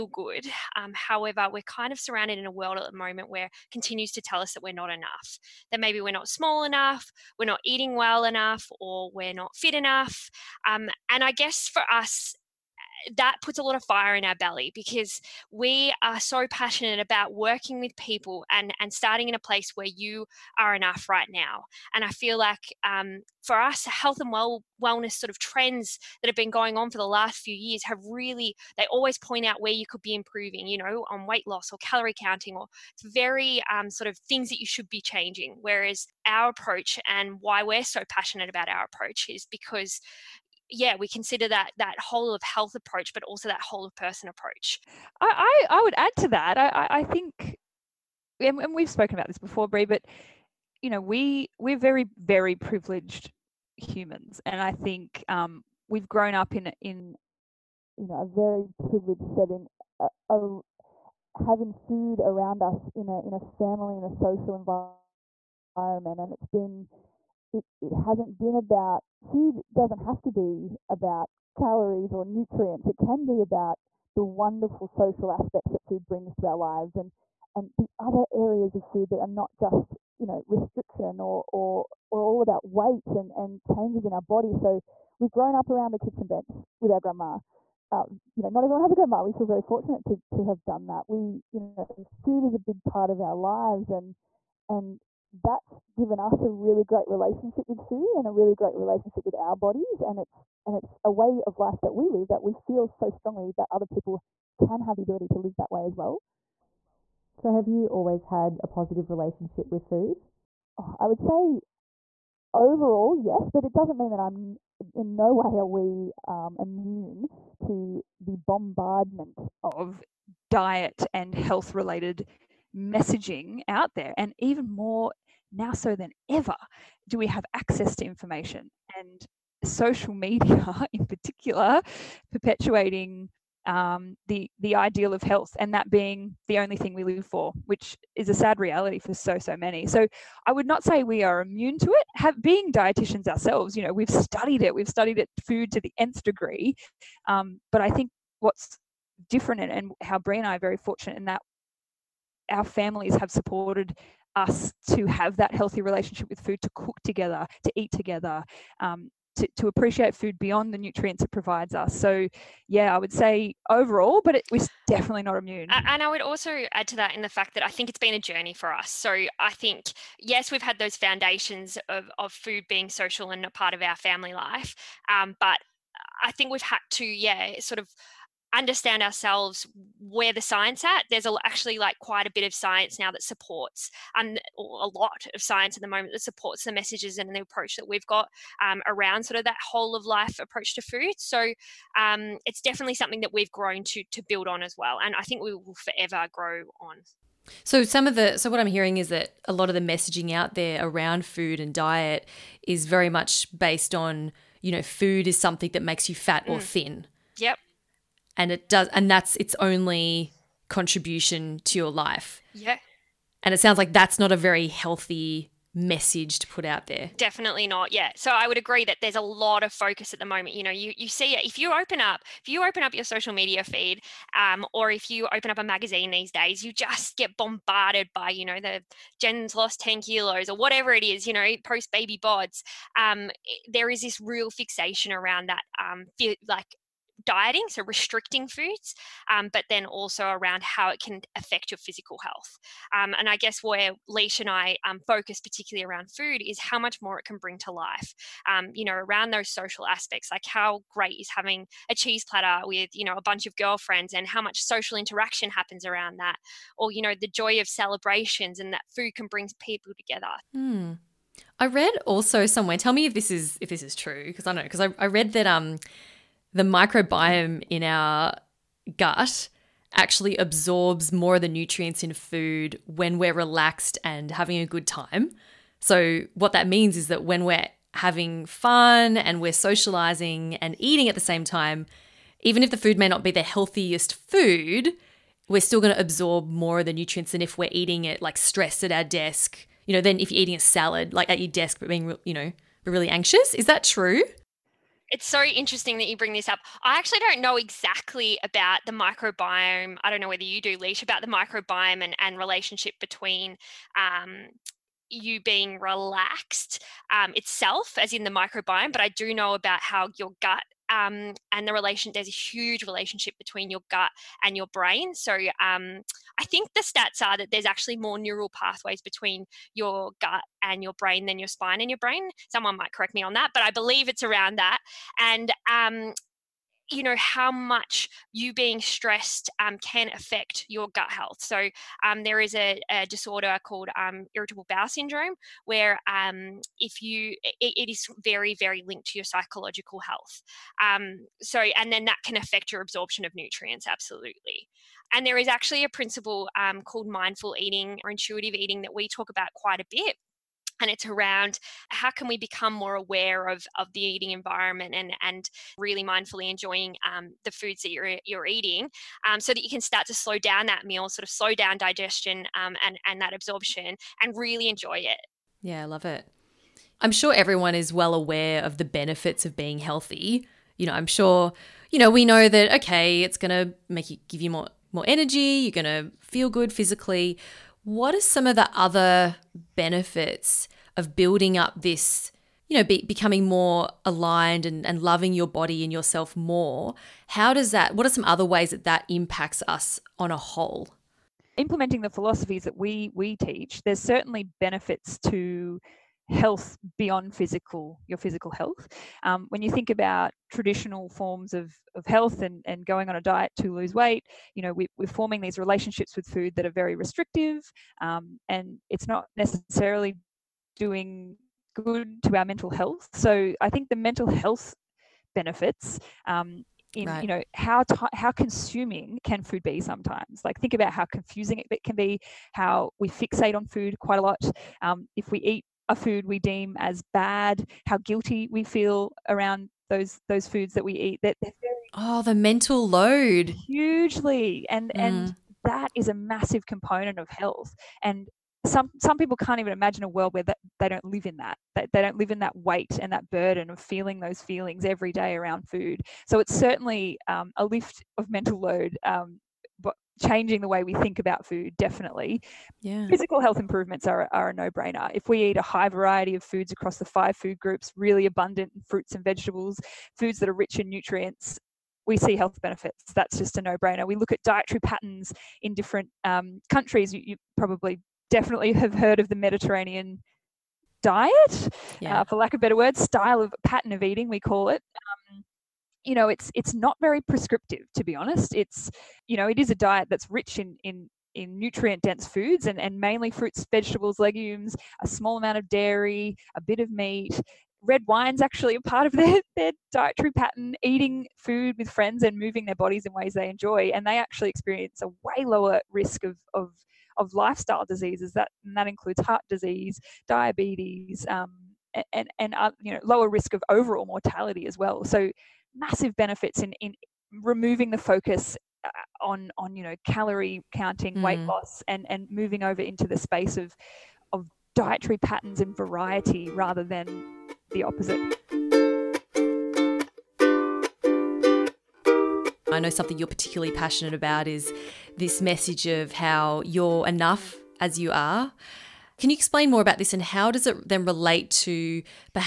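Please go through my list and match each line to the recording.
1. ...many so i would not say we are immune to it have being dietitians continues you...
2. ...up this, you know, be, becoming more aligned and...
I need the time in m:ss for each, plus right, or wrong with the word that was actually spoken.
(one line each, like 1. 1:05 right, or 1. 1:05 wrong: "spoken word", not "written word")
1. 2:19 wrong: "ourselves", not "continues"
2. 6:21 right.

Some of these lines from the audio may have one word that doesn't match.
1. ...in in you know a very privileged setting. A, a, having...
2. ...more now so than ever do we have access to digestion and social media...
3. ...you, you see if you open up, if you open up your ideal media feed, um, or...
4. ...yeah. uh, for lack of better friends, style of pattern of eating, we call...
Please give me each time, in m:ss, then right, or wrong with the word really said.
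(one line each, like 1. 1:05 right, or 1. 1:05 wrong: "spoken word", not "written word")
1. 0:56 right
2. 2:04 wrong: "information", not "digestion"
3. 3:40 wrong: "social", not "ideal"
4. 7:52 wrong: "words", not "friends".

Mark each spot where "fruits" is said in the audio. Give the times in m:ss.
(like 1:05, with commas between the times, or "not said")
7:38, 8:03.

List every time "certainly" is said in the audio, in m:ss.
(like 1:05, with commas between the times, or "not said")
6:33, 7:26.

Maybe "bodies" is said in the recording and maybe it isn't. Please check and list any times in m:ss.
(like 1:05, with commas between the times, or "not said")
1:39, 8:12.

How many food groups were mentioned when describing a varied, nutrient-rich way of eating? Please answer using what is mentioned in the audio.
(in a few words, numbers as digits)
5.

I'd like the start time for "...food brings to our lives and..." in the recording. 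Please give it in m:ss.
1:15.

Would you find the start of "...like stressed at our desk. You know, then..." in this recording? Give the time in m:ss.
4:48.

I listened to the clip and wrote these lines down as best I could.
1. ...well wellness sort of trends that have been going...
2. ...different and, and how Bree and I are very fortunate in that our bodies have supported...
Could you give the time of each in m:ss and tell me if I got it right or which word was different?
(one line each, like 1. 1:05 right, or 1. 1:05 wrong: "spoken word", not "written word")
1. 0:24 right
2. 2:29 wrong: "families", not "bodies".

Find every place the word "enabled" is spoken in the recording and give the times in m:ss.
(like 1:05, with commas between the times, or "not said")
not said.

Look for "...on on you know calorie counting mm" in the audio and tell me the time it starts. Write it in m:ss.
8:29.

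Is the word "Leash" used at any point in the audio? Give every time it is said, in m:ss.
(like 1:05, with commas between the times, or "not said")
4:04, 5:00.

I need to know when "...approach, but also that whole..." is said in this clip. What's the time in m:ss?
0:42.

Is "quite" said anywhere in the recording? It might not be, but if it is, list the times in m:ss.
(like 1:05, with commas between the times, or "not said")
3:01, 5:49, 7:03.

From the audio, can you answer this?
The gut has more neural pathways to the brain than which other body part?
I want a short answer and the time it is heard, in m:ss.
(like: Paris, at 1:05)
spine, at 5:21.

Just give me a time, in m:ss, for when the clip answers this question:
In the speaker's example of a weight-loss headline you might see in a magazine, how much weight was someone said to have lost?
3:49.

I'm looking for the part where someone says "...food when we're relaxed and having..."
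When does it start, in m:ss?
4:32.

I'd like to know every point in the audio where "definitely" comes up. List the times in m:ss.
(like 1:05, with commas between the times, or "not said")
2:44, 3:12, 3:37, 7:31, 7:48.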